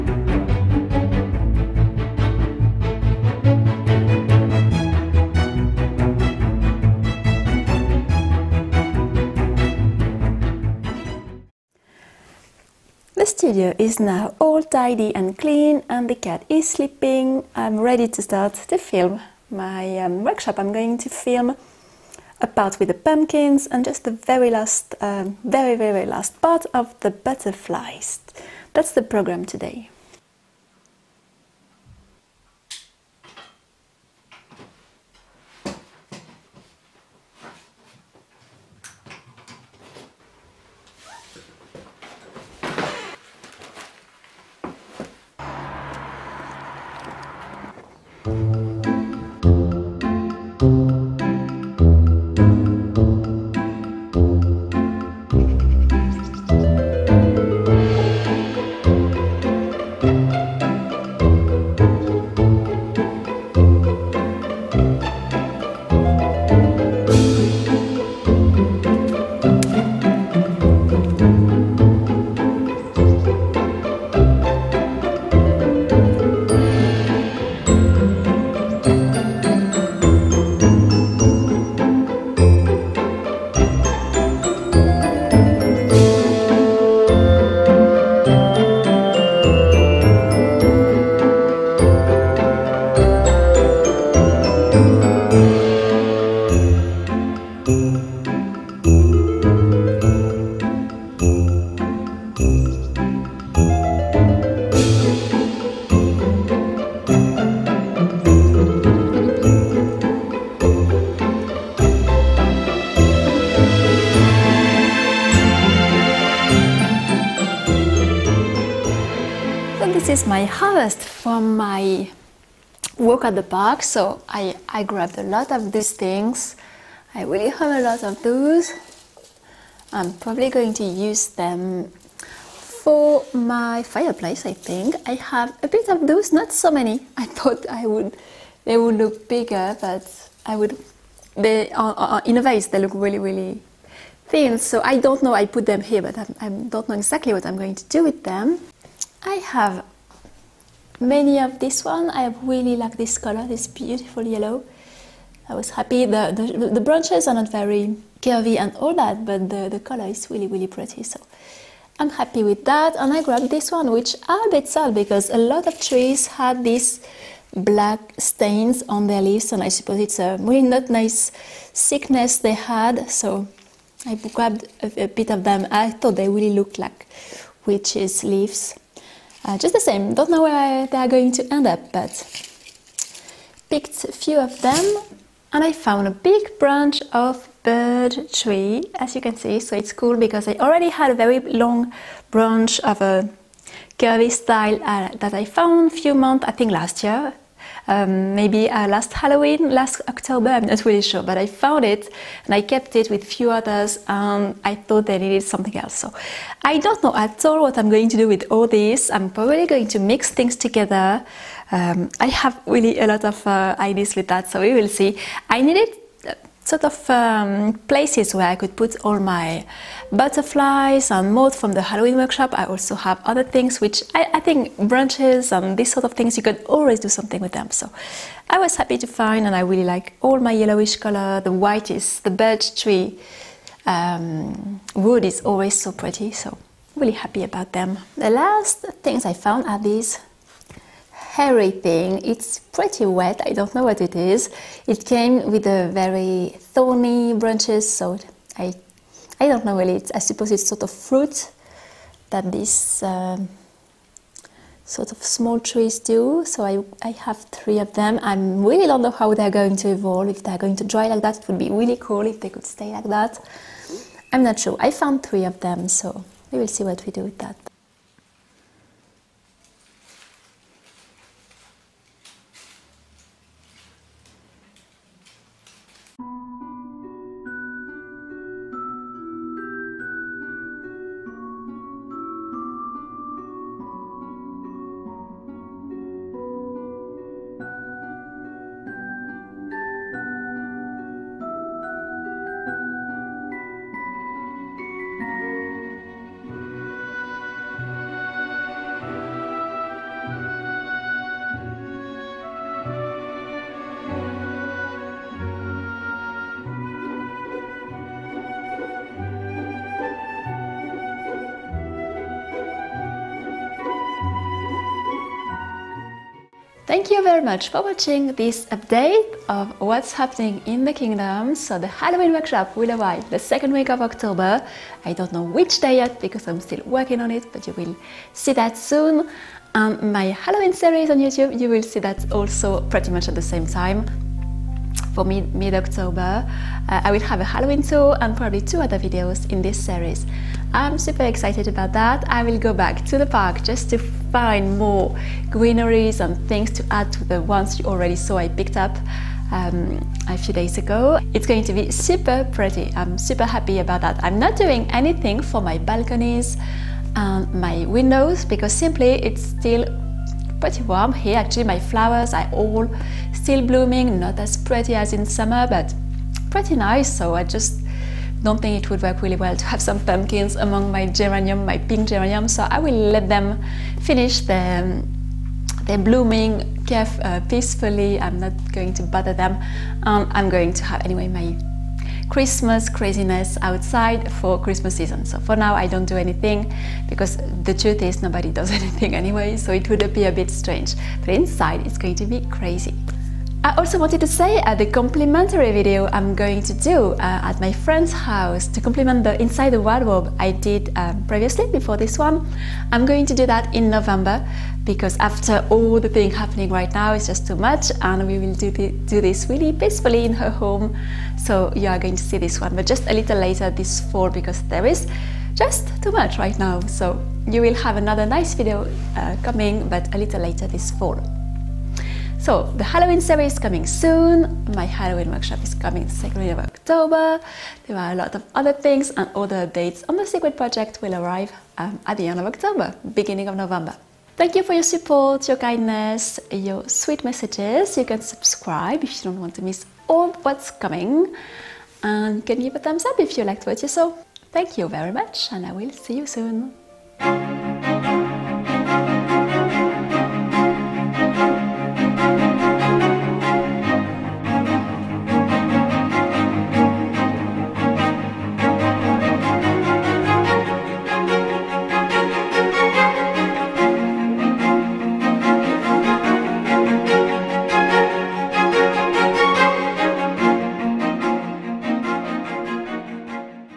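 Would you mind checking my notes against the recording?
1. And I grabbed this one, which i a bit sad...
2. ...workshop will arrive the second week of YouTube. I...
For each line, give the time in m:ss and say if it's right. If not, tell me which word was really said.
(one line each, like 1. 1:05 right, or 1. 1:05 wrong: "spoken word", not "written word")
1. 2:42 right
2. 5:22 wrong: "October", not "YouTube".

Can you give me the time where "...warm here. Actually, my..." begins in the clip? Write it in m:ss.
6:00.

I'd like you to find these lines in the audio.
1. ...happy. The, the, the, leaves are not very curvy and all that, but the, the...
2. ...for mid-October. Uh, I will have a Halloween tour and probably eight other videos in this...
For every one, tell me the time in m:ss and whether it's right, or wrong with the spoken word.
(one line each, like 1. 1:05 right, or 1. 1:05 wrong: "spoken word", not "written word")
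1. 2:35 wrong: "branches", not "leaves"
2. 5:35 wrong: "two", not "eight".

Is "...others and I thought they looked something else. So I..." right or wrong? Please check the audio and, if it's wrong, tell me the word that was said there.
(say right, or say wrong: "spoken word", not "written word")
wrong: "needed", not "looked".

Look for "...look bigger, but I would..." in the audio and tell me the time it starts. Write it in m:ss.
2:18.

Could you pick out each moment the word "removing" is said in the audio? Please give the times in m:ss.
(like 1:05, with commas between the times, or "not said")
not said.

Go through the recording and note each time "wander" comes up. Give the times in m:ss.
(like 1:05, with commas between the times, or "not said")
not said.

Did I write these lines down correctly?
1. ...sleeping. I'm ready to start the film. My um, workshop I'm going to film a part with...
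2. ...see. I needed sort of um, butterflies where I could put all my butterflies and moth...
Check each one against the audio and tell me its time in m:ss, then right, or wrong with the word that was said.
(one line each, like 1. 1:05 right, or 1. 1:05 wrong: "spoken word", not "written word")
1. 0:16 right
2. 3:34 wrong: "places", not "butterflies".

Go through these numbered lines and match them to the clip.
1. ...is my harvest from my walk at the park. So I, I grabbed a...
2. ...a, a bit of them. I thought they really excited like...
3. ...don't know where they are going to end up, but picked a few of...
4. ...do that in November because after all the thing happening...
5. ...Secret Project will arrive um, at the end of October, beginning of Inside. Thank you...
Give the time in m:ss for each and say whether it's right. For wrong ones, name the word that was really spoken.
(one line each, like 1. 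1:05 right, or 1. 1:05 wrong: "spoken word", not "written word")
1. 2:00 right
2. 2:54 wrong: "looked", not "excited"
3. 3:00 right
4. 6:43 right
5. 7:10 wrong: "November", not "Inside".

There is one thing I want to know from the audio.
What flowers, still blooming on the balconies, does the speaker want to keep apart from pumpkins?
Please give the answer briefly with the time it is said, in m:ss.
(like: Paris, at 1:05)
pink geranium, at 6:11.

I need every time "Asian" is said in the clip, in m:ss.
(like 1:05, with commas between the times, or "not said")
not said.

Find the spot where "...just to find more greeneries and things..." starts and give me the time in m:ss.
5:43.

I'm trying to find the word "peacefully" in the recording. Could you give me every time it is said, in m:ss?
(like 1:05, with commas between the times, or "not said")
6:17, 6:49.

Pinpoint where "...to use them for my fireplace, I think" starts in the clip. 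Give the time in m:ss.
2:10.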